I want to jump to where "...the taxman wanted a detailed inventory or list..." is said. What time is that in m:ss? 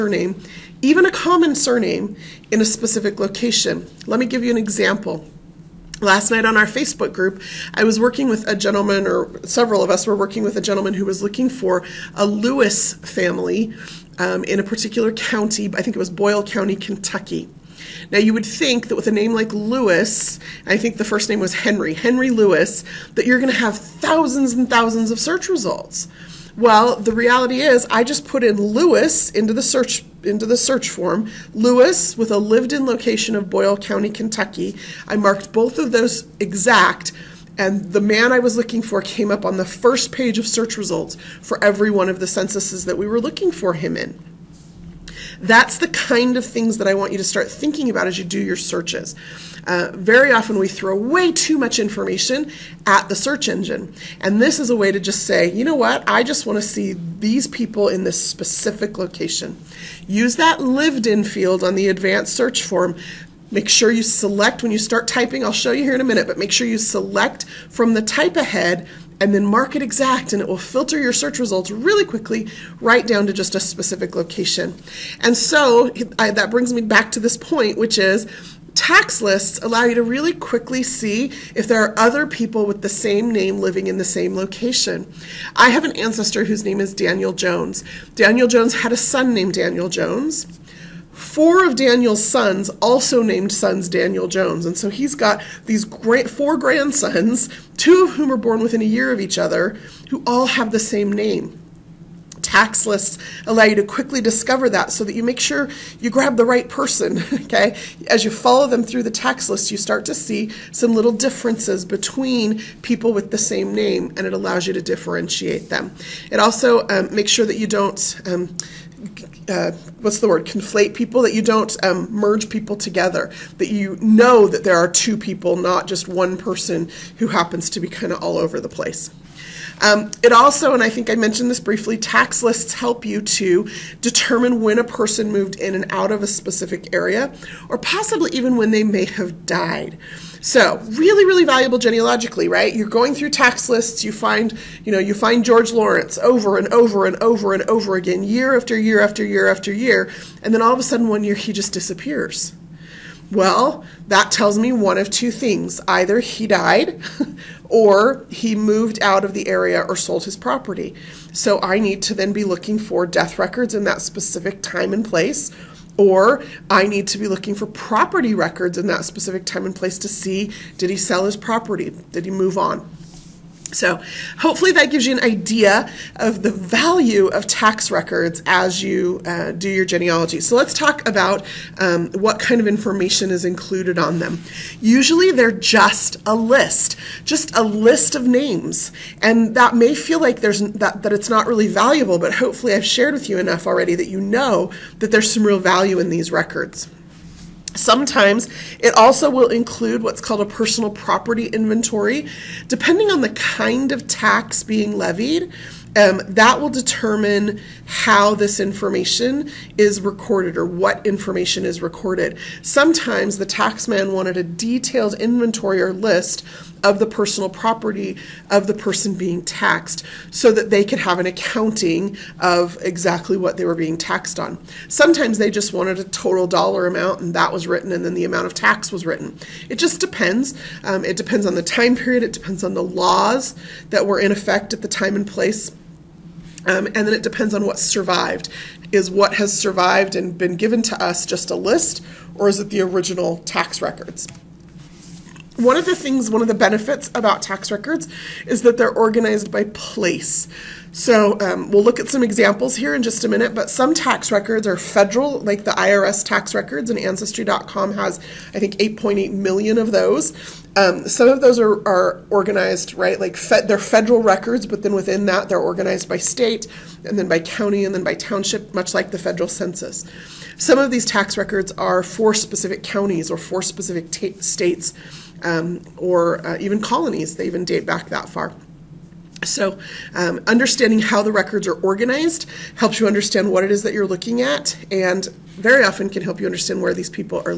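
3:33.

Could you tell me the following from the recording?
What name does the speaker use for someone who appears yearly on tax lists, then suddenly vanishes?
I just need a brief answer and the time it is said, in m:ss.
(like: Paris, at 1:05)
George Lawrence, at 2:25.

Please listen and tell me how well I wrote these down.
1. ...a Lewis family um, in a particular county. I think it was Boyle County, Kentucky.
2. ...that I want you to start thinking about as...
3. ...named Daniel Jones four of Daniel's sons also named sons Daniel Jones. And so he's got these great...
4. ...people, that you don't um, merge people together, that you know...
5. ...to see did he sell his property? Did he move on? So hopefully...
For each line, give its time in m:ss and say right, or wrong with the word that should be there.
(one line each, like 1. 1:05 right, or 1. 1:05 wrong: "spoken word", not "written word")
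1. 0:12 right
2. 0:46 right
3. 1:29 right
4. 2:00 right
5. 2:49 right.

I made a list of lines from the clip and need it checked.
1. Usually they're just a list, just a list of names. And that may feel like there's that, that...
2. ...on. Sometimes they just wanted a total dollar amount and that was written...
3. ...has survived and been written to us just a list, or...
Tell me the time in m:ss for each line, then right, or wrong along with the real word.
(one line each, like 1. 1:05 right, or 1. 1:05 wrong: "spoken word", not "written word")
1. 3:04 right
2. 3:44 right
3. 3:59 wrong: "given", not "written".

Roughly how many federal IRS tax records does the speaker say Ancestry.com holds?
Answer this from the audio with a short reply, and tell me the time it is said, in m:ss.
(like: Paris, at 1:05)
8.8 million, at 4:18.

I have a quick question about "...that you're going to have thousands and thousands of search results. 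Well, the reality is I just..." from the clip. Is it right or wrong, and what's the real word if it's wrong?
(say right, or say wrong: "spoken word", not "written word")
right.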